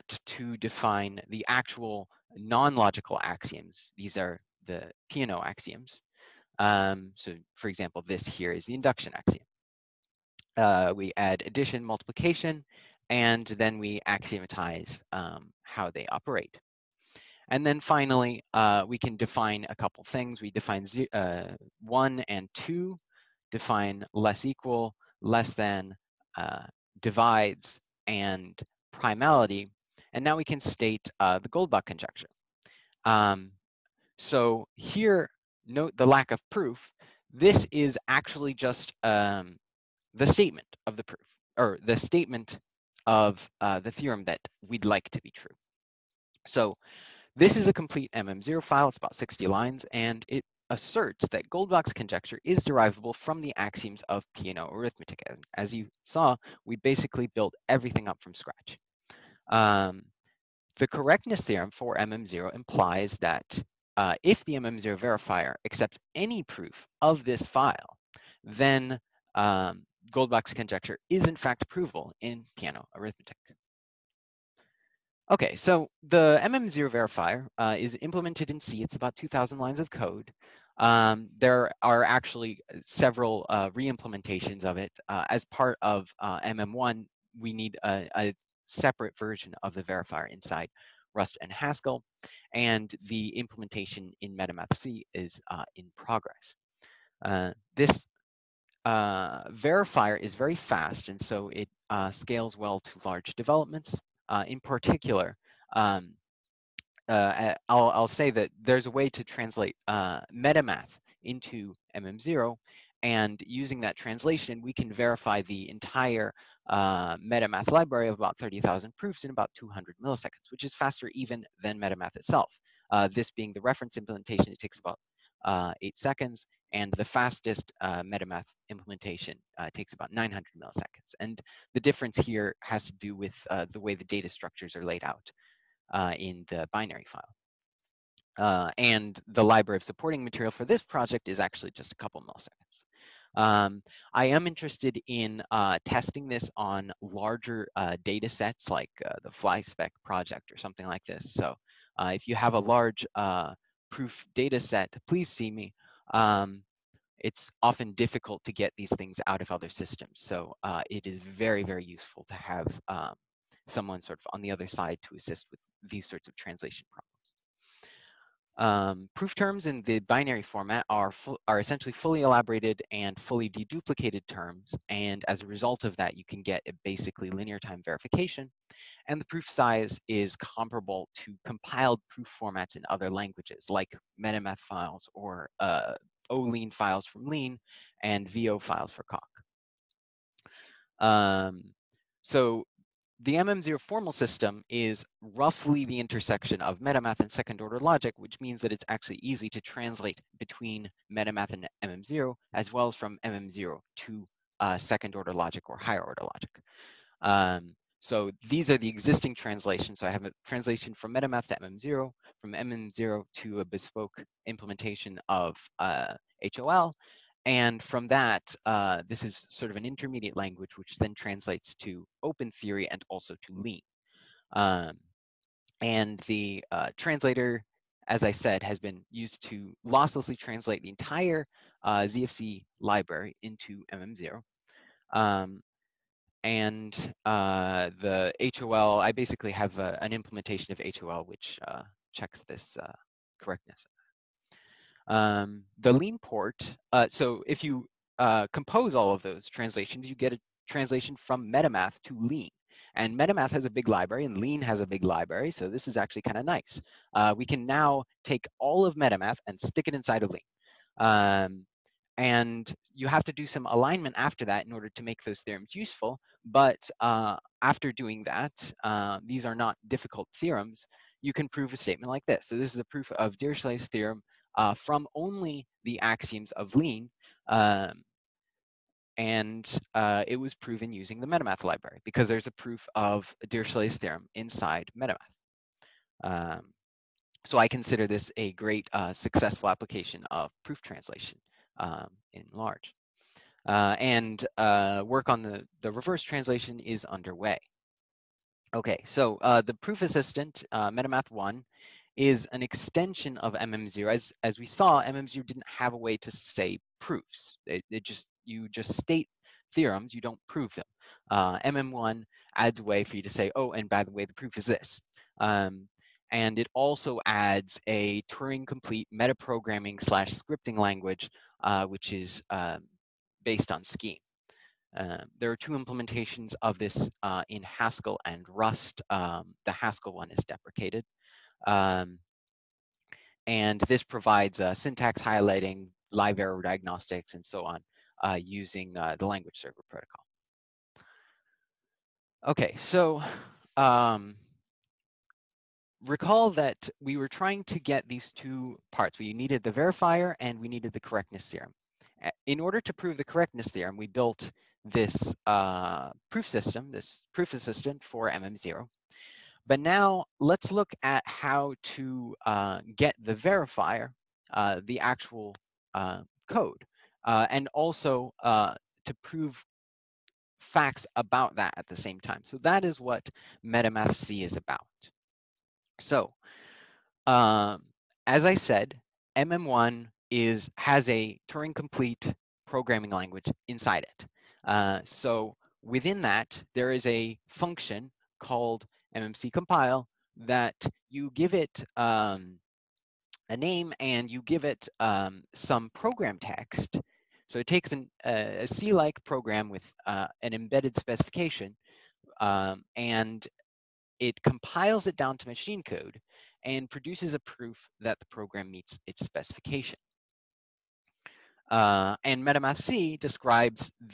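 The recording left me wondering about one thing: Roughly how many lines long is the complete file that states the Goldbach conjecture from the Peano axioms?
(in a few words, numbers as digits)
60.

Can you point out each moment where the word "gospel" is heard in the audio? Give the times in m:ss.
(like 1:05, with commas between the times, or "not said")
not said.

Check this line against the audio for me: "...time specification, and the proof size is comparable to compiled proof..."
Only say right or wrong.
wrong.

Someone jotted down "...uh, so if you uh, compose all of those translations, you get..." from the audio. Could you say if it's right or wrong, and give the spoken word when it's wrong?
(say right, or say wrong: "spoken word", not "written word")
right.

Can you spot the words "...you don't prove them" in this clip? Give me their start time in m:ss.
5:10.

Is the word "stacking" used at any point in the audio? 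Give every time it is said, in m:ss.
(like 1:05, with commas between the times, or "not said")
not said.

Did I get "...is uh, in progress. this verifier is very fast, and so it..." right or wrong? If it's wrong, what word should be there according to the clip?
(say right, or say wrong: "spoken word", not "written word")
right.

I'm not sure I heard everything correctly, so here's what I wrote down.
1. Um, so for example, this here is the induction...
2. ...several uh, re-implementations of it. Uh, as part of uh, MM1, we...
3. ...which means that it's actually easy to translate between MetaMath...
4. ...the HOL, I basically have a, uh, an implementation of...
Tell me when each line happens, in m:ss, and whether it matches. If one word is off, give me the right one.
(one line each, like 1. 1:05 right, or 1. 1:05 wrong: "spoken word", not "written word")
1. 0:06 right
2. 1:22 right
3. 3:18 right
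4. 3:57 right.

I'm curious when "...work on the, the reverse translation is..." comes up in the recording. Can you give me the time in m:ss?
4:55.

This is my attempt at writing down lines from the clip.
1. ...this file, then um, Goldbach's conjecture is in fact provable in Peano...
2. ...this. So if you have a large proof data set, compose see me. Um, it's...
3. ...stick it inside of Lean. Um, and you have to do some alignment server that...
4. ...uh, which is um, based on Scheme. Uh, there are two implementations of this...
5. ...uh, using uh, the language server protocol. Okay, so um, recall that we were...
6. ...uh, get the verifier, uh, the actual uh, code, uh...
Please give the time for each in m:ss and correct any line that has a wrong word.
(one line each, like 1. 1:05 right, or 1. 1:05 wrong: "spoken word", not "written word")
1. 1:07 right
2. 2:31 wrong: "please", not "compose"
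3. 4:19 wrong: "after", not "server"
4. 5:21 right
5. 5:38 right
6. 6:02 right.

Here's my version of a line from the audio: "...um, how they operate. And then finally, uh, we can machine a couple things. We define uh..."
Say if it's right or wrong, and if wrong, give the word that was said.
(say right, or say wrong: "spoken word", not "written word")
wrong: "define", not "machine".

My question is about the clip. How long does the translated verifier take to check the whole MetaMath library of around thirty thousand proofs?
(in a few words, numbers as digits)
200 milliseconds.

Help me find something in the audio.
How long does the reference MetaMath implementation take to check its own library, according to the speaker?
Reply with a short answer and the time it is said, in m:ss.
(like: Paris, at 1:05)
8 seconds, at 2:05.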